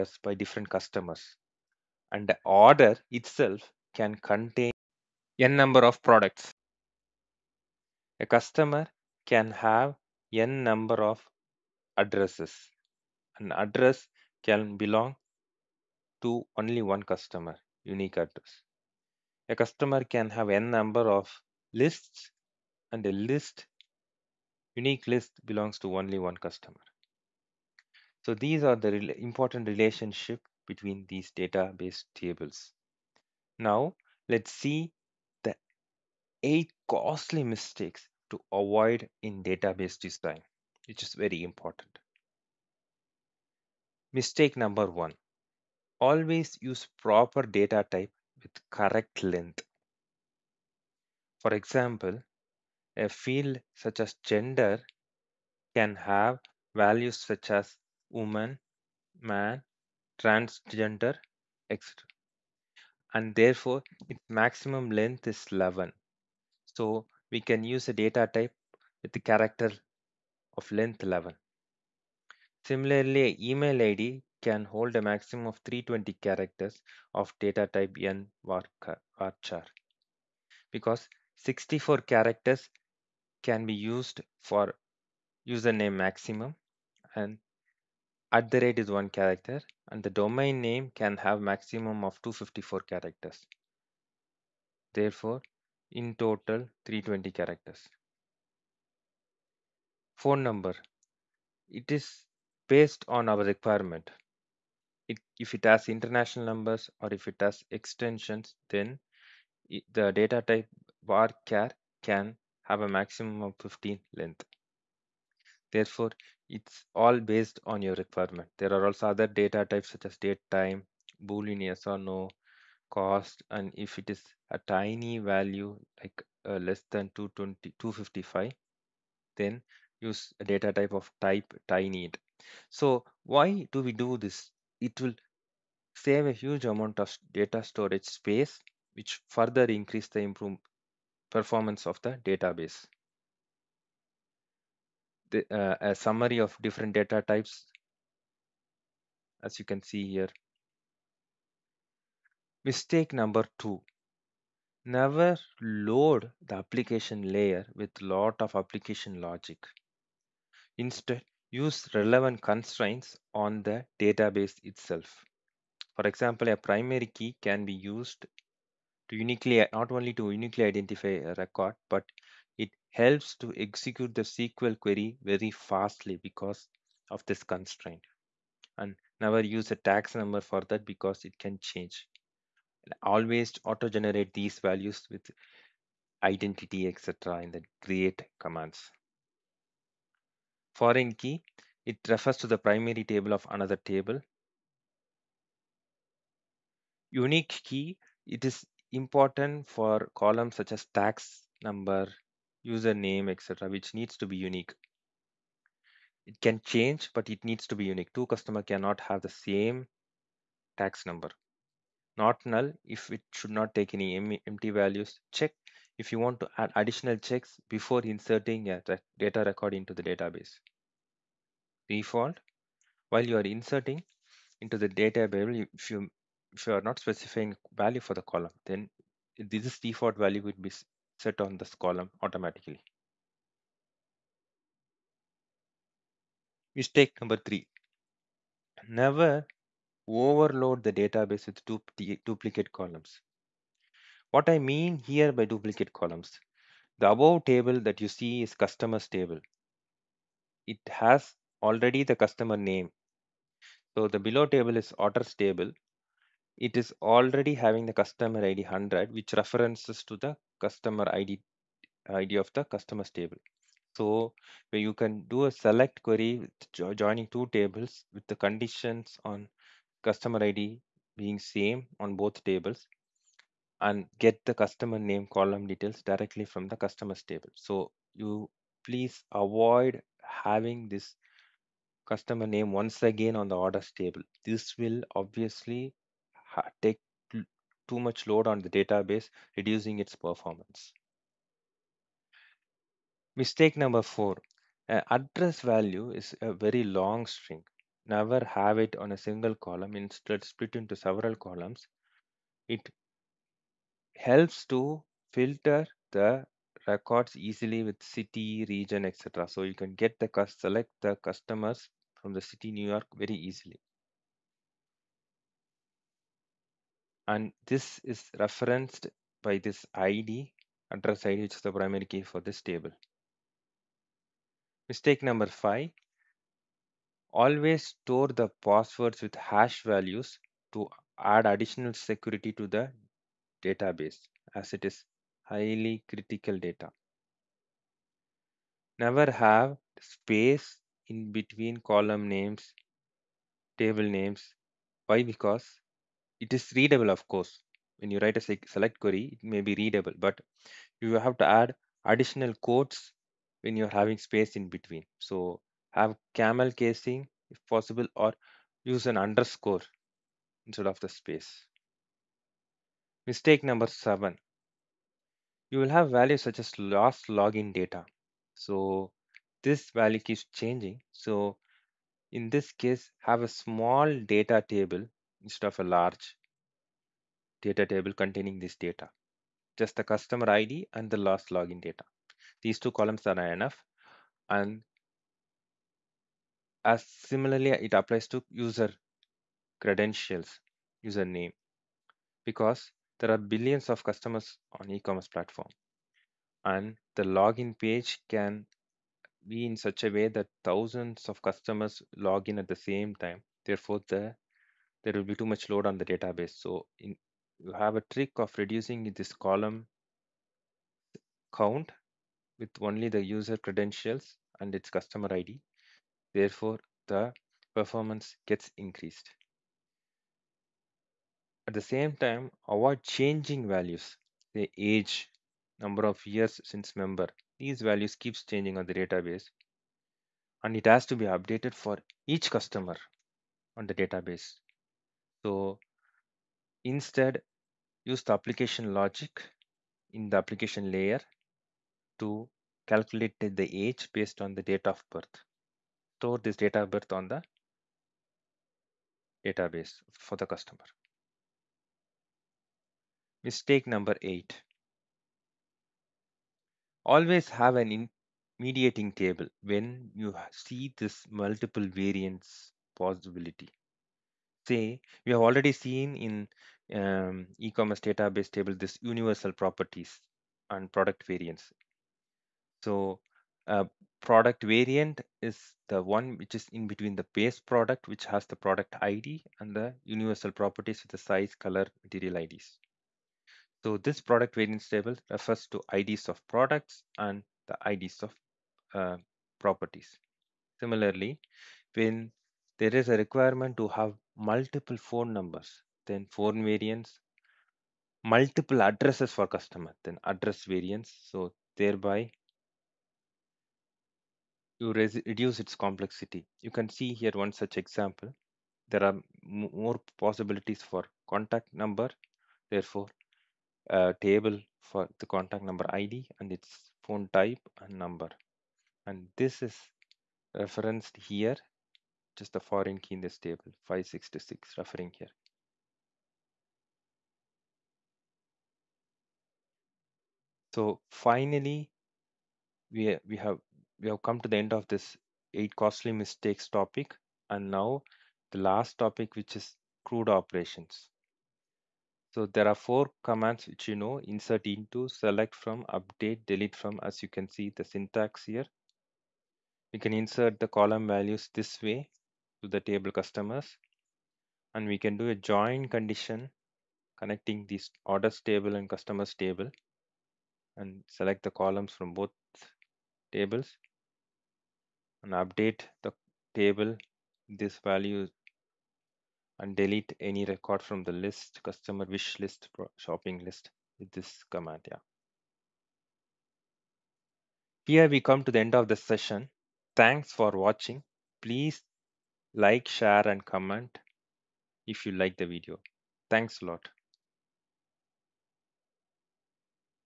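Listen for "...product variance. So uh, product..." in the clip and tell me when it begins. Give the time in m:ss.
7:50.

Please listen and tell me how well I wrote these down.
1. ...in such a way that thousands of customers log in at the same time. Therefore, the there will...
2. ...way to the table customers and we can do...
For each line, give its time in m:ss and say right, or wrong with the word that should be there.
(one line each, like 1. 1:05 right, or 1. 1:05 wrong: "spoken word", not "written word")
1. 6:39 right
2. 9:11 right.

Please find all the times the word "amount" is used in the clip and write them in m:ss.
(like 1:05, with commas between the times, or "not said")
2:16.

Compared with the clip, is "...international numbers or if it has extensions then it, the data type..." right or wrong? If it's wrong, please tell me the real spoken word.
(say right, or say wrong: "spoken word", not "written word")
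right.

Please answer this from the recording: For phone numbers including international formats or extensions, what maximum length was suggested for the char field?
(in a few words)
15.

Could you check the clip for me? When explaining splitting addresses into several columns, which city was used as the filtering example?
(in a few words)
New York.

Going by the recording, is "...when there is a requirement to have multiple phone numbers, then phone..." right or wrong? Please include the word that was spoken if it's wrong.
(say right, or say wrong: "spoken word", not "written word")
right.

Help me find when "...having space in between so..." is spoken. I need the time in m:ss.
5:54.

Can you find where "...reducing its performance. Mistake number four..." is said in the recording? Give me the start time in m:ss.
4:49.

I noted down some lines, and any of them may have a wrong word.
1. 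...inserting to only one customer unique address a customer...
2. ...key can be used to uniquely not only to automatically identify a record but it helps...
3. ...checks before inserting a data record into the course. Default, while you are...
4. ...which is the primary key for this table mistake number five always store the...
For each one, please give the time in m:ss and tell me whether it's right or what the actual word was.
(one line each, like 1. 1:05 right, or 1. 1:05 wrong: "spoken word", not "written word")
1. 0:14 wrong: "belong", not "inserting"
2. 2:47 wrong: "uniquely", not "automatically"
3. 3:37 wrong: "database", not "course"
4. 5:21 right.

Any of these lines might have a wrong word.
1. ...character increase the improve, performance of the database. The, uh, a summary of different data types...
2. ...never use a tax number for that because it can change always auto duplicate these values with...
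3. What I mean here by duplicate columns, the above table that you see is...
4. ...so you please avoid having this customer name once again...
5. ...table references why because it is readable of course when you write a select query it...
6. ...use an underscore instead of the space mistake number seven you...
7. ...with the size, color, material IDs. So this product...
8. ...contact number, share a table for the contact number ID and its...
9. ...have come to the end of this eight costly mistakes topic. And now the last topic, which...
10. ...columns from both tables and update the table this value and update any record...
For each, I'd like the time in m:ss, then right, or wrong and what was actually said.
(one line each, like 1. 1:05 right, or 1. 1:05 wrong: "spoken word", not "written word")
1. 2:19 wrong: "further", not "character"
2. 2:59 wrong: "generate", not "duplicate"
3. 4:04 right
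4. 4:37 right
5. 5:43 wrong: "names", not "references"
6. 5:58 right
7. 8:01 right
8. 8:31 wrong: "therefore", not "share"
9. 8:54 right
10. 9:21 wrong: "delete", not "update".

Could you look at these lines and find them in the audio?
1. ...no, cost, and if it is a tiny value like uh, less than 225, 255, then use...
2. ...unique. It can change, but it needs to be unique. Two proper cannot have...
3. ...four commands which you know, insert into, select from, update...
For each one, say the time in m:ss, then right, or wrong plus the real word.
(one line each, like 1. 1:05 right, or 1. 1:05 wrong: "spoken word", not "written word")
1. 2:01 wrong: "220", not "225"
2. 3:24 wrong: "customer", not "proper"
3. 9:02 right.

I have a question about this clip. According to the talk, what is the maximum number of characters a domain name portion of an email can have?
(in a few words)
254.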